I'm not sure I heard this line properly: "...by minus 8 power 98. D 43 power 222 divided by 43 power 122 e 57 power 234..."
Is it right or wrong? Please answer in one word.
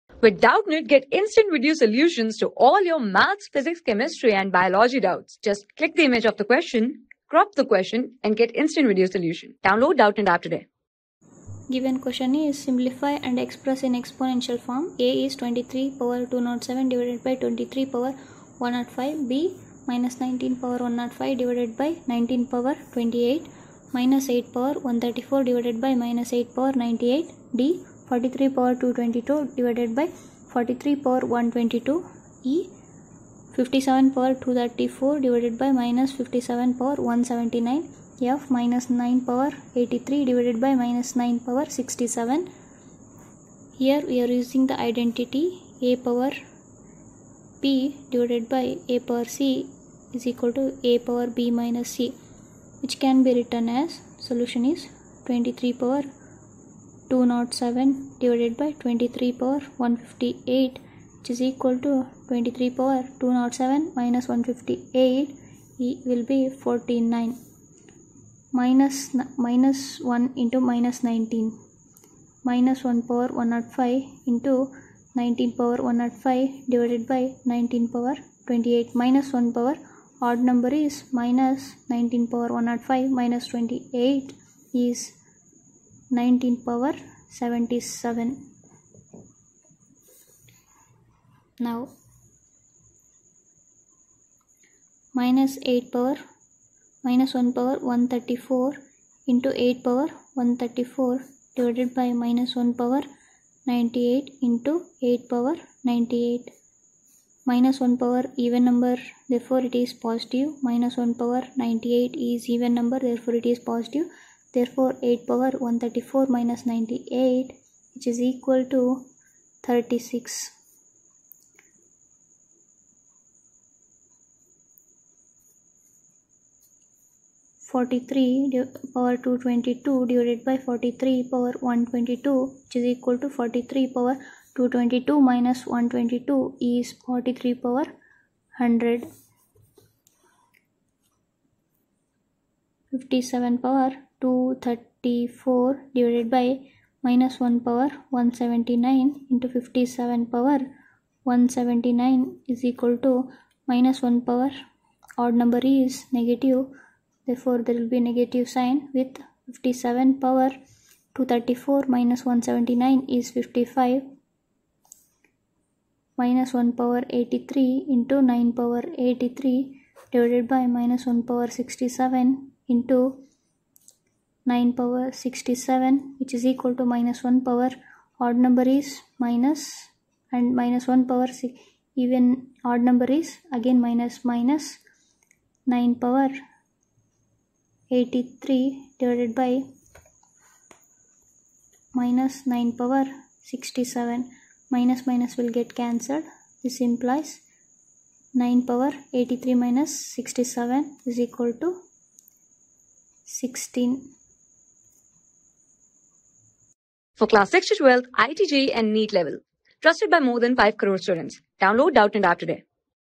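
right.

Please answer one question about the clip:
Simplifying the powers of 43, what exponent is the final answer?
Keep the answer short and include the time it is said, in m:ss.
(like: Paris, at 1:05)
100, at 2:17.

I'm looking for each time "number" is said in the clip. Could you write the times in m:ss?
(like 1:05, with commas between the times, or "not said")
1:20, 1:48, 1:52, 2:35, 2:58, 3:02.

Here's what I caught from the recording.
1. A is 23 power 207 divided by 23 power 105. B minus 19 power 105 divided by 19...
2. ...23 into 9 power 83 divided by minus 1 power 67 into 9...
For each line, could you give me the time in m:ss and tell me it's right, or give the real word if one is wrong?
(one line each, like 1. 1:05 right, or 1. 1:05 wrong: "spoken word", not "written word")
1. 0:14 right
2. 2:47 wrong: "83", not "23".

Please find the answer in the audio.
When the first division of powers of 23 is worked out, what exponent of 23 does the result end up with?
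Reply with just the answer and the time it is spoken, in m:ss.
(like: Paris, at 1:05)
49, at 1:06.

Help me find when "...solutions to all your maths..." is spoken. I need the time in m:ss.
0:01.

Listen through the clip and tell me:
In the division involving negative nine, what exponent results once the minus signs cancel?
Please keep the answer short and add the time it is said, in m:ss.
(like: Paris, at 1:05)
16, at 3:21.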